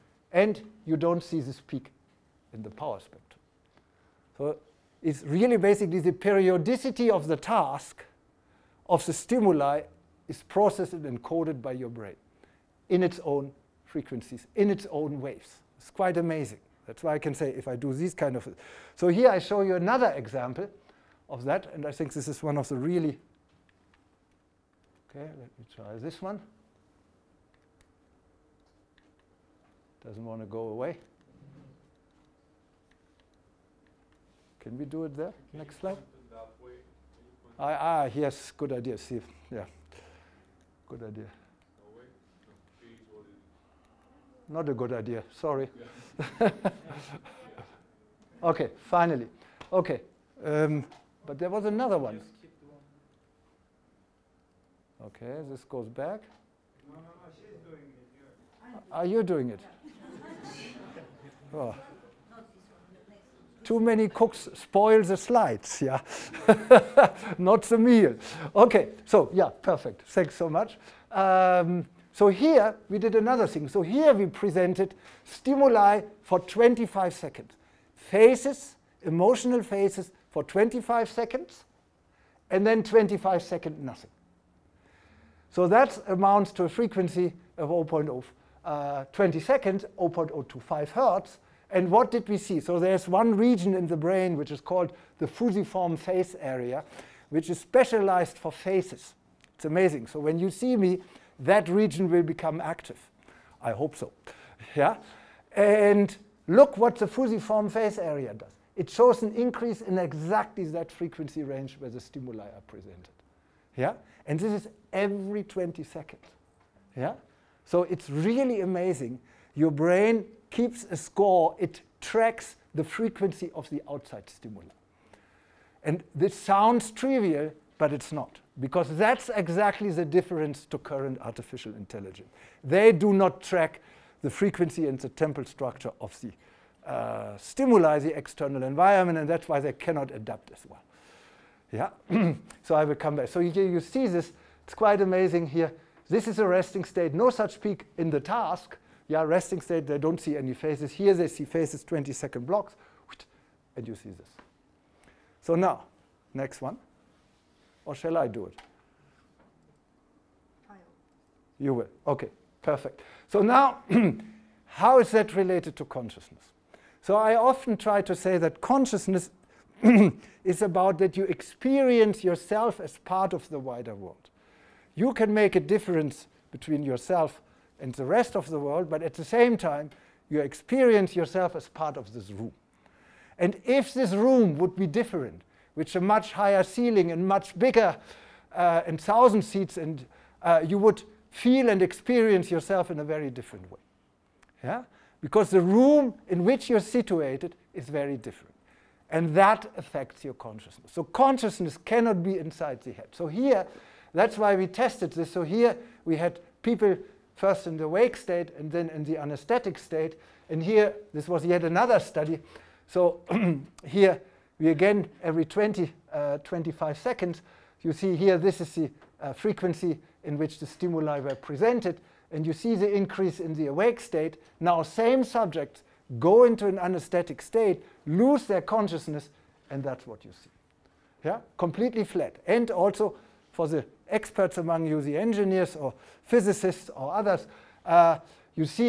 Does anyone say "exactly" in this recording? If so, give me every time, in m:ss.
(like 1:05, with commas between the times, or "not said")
1:49, 2:09.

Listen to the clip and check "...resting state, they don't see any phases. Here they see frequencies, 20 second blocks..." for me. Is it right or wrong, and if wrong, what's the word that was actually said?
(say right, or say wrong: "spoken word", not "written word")
wrong: "phases", not "frequencies".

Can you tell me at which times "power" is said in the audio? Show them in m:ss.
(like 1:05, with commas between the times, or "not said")
0:02.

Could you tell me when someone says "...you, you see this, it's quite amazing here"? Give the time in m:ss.
2:23.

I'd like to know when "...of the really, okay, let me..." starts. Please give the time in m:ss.
0:22.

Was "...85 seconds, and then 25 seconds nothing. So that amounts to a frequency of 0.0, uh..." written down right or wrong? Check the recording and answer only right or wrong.
wrong.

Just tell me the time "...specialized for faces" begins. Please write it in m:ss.
1:37.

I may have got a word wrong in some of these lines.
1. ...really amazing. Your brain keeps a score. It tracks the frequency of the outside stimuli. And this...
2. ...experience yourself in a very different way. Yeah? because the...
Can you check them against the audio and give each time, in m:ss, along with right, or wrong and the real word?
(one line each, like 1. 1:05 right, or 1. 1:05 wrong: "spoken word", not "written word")
1. 1:58 right
2. 3:11 right.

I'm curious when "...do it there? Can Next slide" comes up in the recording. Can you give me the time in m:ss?
0:34.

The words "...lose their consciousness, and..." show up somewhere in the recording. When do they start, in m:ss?
3:48.